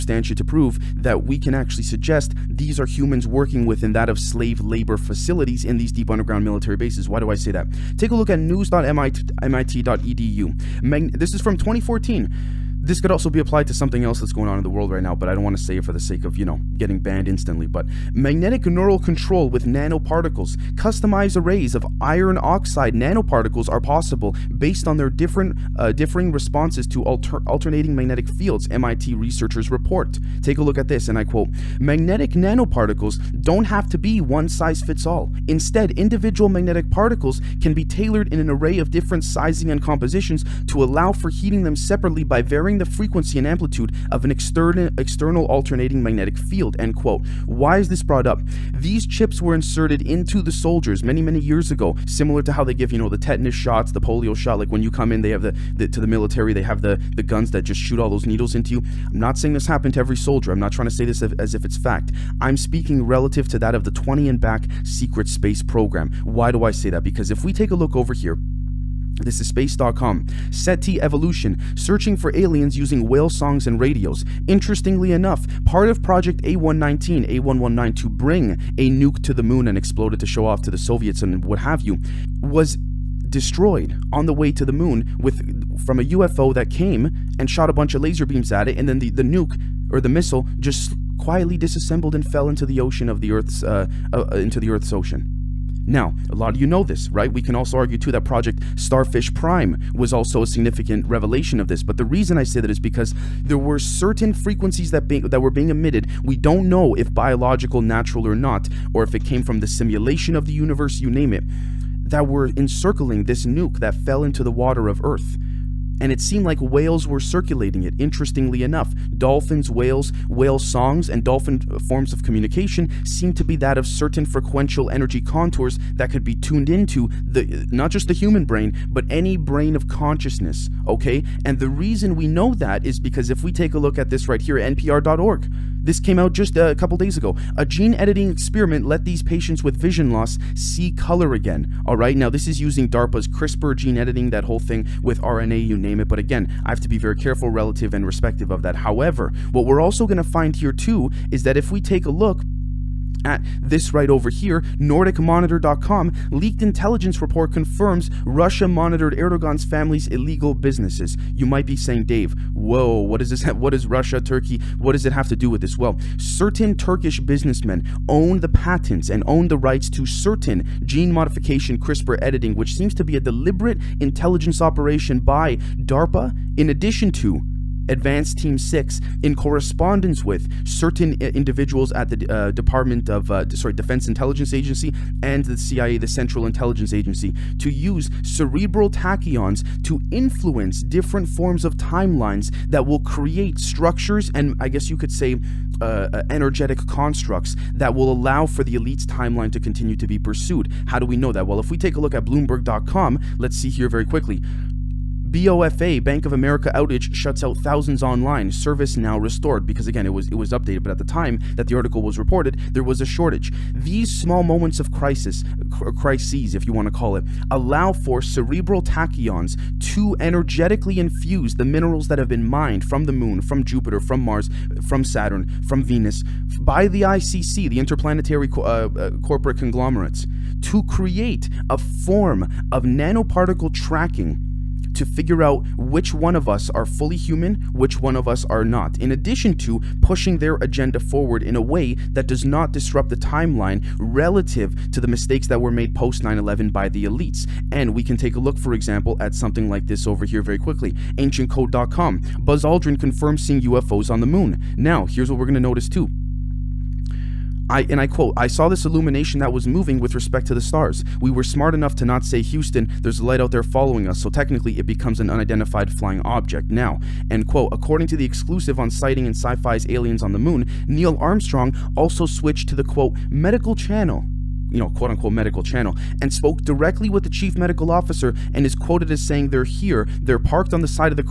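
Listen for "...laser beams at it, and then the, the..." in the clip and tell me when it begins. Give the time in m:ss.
1:28.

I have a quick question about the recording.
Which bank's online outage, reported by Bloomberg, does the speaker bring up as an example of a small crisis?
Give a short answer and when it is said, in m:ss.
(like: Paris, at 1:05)
Bank of America, at 3:26.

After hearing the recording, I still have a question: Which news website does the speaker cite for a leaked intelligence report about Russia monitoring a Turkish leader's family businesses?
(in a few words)
NordicMonitor.com.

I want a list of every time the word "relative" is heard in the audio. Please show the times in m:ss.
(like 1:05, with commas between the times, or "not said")
1:03, 2:27, 4:03.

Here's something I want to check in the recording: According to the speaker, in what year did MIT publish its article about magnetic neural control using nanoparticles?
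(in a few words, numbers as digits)
2014.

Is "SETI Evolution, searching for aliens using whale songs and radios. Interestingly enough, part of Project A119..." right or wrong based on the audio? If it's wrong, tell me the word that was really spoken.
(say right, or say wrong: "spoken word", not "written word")
right.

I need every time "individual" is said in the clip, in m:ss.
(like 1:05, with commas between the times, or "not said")
0:35, 3:01.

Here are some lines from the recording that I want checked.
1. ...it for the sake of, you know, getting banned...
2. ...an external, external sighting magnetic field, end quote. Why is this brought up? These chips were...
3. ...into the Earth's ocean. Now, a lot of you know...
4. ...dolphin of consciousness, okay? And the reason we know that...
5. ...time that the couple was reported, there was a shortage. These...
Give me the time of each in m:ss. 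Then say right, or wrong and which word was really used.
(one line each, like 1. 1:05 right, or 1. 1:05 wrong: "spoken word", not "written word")
1. 0:15 right
2. 0:44 wrong: "alternating", not "sighting"
3. 1:34 right
4. 2:09 wrong: "brain", not "dolphin"
5. 3:31 wrong: "article", not "couple".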